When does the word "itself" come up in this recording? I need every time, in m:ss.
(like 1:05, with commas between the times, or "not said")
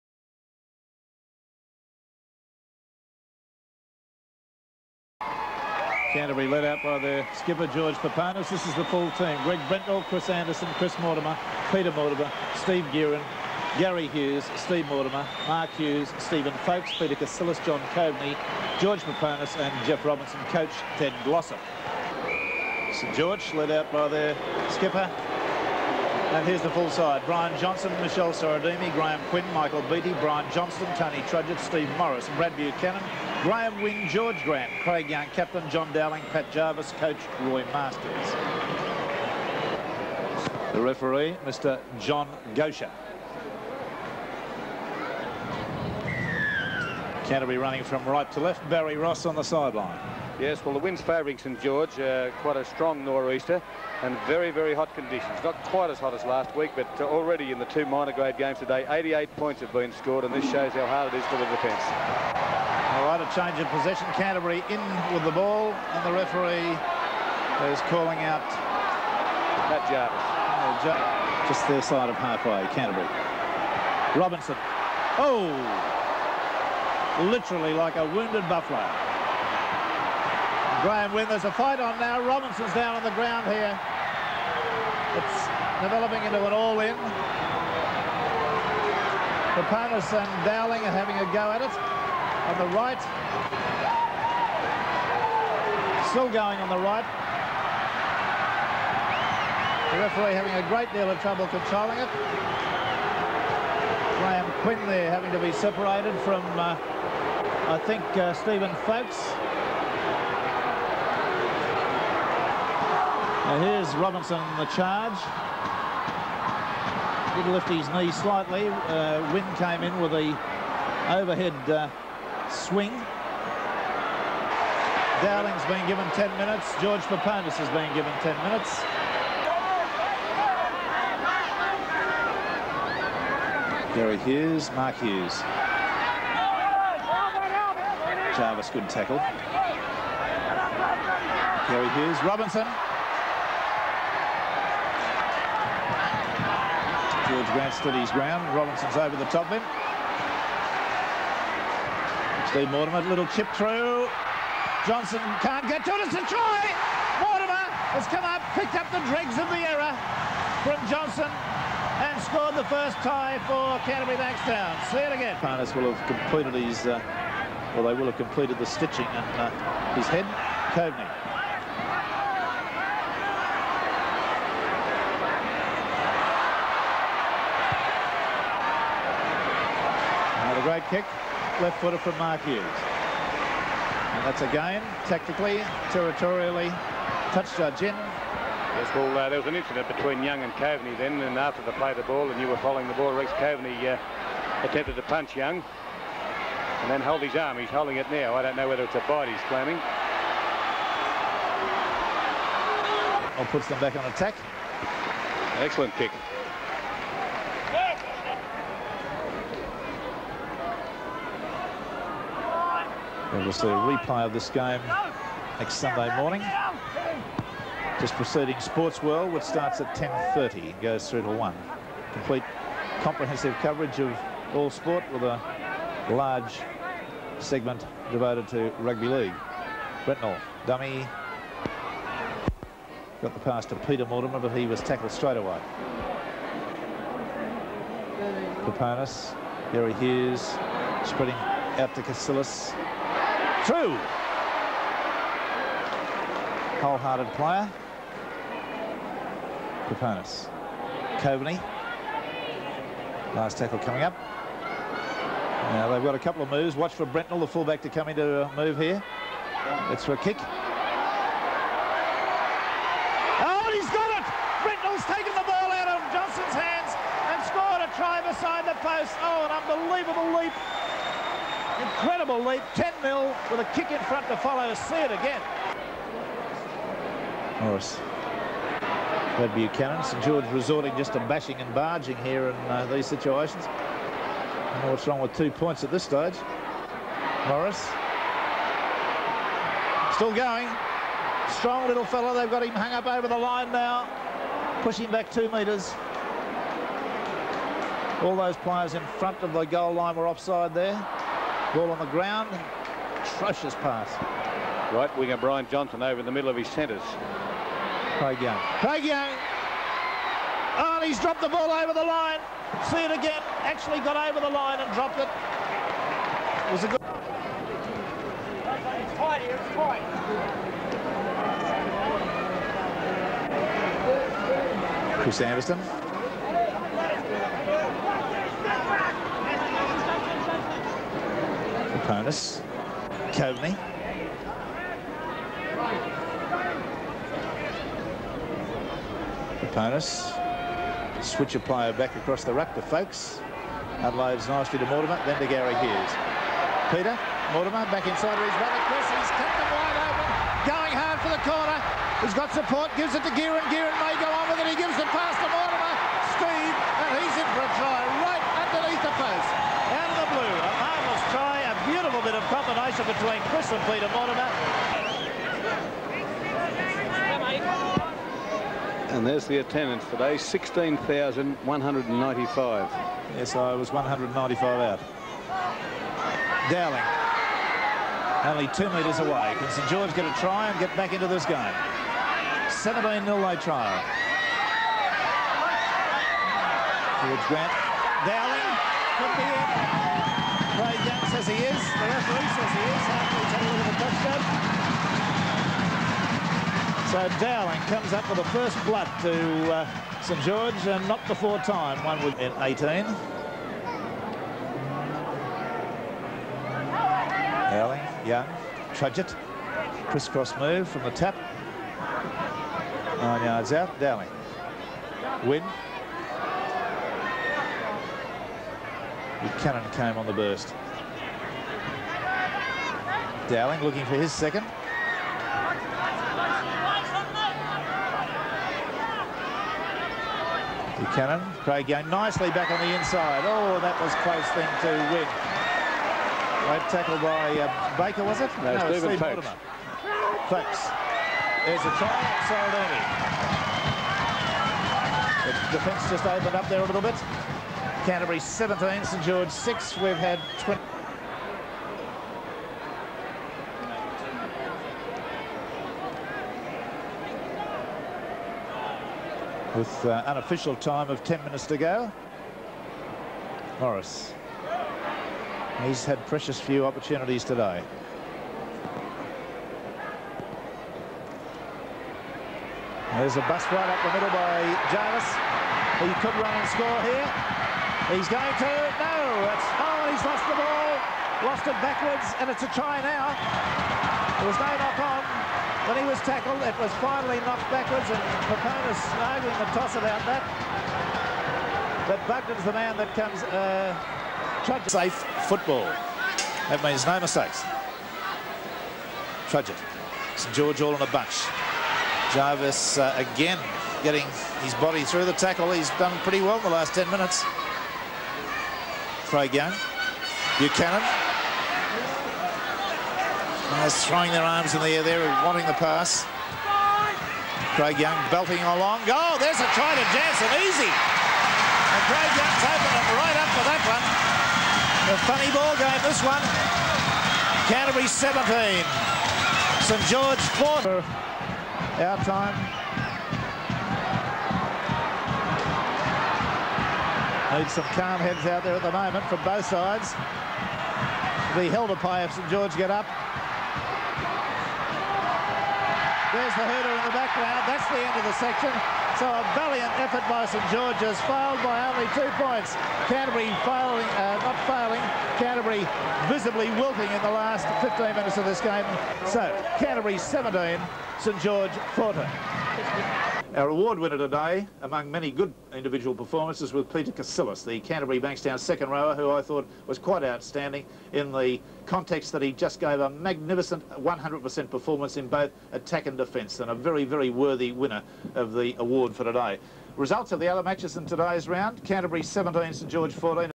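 not said.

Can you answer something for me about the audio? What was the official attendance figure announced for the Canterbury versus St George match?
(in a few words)
16,195.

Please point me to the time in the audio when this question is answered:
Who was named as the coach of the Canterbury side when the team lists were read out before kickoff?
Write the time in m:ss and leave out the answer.
0:20.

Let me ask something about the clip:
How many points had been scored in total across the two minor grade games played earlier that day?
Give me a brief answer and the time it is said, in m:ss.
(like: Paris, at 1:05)
88, at 0:58.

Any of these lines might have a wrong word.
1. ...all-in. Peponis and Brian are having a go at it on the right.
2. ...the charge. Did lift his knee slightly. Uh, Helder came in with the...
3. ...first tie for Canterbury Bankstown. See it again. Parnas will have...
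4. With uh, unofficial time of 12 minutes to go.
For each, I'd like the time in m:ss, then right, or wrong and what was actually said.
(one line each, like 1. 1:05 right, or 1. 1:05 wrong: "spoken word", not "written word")
1. 1:26 wrong: "Dowling", not "Brian"
2. 1:54 wrong: "Wynn", not "Helder"
3. 2:42 right
4. 7:39 wrong: "10", not "12".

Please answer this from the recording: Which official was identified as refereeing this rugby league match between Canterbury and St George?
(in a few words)
John Gocher.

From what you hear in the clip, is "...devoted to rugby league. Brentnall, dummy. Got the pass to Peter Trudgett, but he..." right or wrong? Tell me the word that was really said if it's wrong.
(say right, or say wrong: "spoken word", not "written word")
wrong: "Mortimer", not "Trudgett".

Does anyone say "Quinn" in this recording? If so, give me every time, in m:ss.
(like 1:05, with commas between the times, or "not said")
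0:29, 1:44.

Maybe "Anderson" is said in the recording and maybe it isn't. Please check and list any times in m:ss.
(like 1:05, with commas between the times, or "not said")
0:10, 5:25.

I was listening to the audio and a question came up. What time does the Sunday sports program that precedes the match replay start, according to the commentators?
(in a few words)
10.30.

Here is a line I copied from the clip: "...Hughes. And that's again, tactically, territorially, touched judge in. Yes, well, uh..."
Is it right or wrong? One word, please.
right.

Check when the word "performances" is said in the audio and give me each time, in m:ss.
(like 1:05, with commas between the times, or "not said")
9:26, 9:34.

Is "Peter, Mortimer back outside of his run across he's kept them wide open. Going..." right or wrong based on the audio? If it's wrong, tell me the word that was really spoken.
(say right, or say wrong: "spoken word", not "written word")
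wrong: "inside", not "outside".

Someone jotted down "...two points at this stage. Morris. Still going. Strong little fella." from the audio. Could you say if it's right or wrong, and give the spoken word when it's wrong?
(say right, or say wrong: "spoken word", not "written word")
right.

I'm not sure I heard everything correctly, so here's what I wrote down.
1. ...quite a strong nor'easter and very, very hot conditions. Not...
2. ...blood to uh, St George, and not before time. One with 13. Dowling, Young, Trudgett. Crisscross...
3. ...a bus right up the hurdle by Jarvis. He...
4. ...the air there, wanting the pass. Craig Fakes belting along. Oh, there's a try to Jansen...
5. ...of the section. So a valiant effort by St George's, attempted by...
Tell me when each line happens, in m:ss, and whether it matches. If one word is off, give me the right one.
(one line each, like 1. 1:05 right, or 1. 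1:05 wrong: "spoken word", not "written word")
1. 0:52 right
2. 6:38 wrong: "18", not "13"
3. 7:53 wrong: "middle", not "hurdle"
4. 8:34 wrong: "Young", not "Fakes"
5. 9:08 wrong: "failed", not "attempted".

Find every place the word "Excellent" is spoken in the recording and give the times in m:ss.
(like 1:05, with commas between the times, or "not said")
3:25.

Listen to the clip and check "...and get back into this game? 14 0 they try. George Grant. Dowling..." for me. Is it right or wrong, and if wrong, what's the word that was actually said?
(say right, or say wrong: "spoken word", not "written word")
wrong: "17", not "14".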